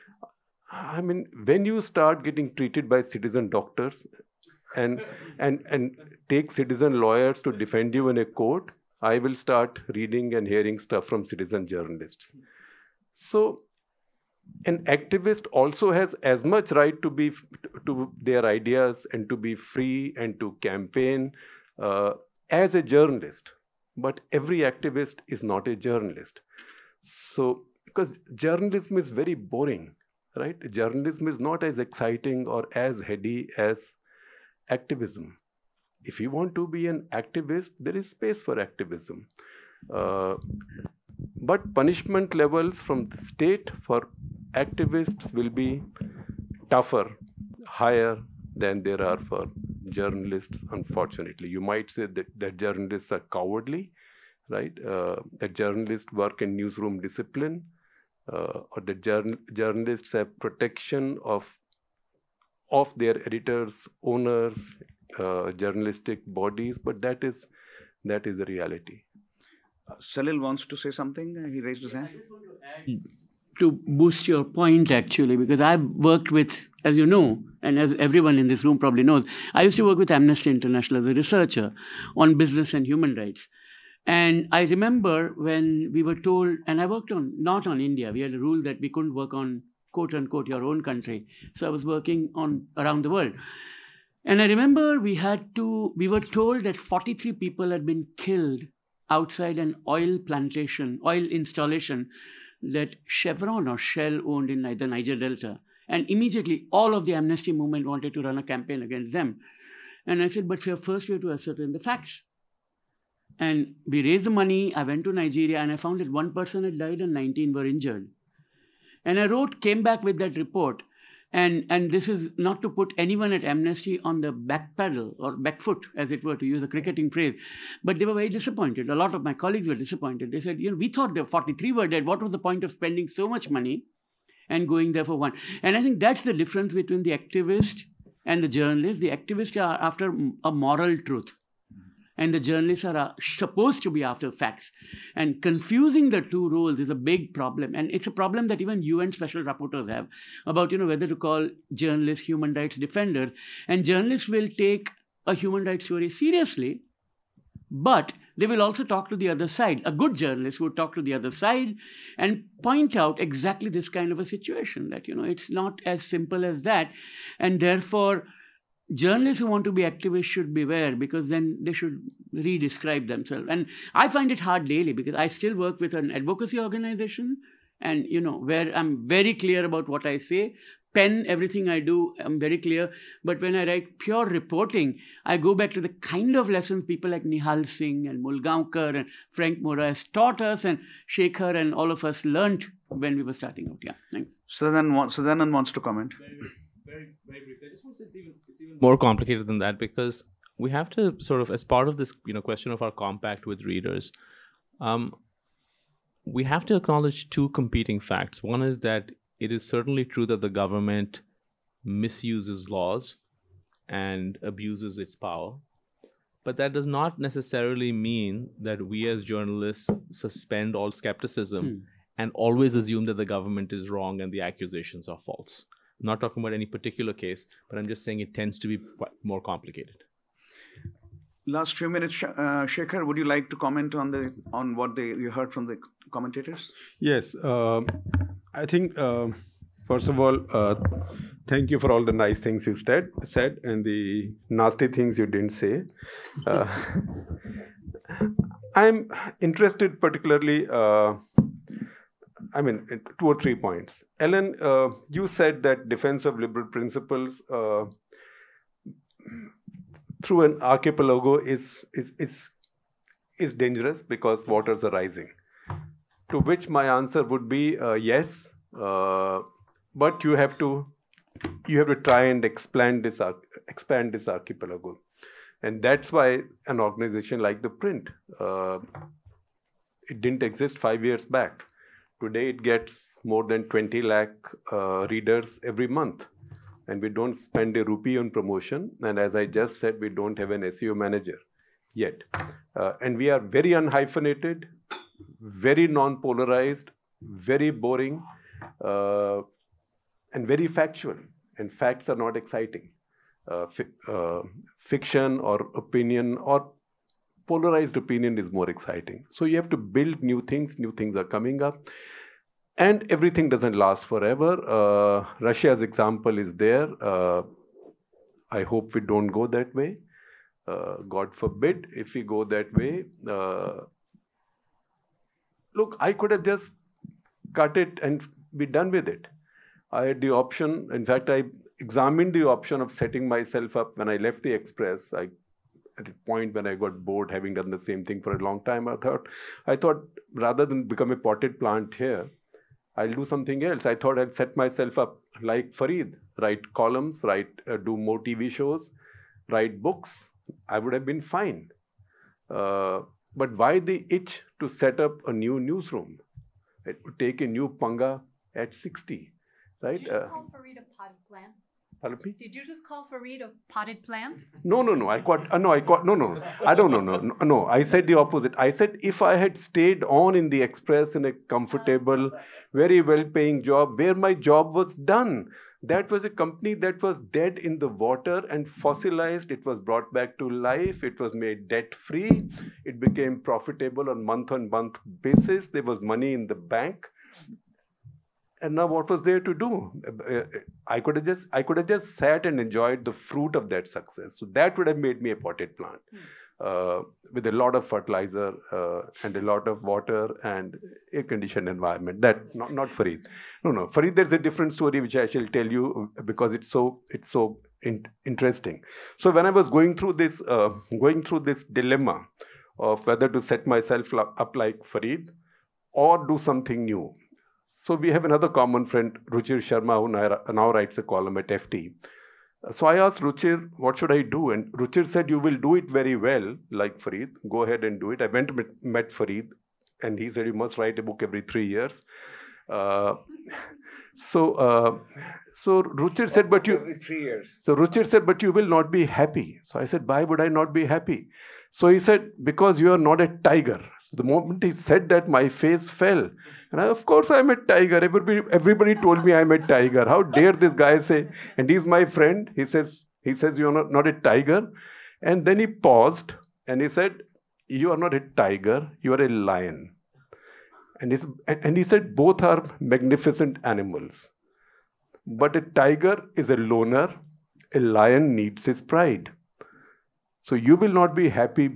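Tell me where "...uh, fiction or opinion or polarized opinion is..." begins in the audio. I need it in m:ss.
5:04.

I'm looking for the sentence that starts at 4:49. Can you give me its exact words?
And as I just said, we don't have an SEO manager yet.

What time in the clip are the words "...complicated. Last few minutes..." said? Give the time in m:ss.
3:49.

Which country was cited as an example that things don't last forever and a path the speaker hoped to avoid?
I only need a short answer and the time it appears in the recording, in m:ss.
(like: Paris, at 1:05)
Russia, at 5:15.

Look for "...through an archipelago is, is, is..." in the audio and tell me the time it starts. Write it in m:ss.
4:20.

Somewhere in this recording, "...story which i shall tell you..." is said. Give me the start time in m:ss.
6:44.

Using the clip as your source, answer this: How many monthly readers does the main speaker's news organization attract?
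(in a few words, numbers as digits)
20 lakh.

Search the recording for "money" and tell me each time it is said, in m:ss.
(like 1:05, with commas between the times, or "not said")
1:54, 2:13, 6:26.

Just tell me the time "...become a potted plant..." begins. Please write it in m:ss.
5:40.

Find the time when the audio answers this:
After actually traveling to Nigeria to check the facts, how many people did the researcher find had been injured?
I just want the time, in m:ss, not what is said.
1:57.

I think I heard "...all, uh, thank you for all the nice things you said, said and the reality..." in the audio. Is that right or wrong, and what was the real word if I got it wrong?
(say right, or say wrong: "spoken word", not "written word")
wrong: "nasty", not "reality".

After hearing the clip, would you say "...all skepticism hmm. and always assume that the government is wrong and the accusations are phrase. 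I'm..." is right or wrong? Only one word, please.
wrong.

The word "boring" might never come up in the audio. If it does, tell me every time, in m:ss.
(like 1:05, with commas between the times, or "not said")
0:29, 4:57.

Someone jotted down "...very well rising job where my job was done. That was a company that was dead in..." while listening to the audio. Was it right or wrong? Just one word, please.
wrong.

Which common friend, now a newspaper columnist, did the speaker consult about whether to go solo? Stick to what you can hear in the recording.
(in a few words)
Ruchir Sharma.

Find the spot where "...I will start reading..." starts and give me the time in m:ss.
0:09.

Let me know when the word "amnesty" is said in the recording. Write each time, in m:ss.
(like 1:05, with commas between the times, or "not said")
1:20, 1:47, 2:03.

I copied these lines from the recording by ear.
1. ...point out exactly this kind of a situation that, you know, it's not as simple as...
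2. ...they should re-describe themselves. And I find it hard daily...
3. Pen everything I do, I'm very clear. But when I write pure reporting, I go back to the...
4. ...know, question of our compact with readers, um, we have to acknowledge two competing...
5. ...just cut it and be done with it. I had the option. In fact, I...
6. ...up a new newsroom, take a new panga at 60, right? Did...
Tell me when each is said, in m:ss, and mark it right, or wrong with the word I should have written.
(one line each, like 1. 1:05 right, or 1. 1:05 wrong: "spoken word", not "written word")
1. 2:42 right
2. 2:51 right
3. 3:00 right
4. 3:22 right
5. 5:26 right
6. 5:54 right.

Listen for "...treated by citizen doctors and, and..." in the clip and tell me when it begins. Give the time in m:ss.
0:02.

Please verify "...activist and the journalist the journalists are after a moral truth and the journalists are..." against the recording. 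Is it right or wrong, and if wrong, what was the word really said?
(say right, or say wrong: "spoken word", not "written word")
wrong: "activists", not "journalists".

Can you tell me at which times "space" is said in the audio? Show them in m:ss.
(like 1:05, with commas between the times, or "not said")
0:38.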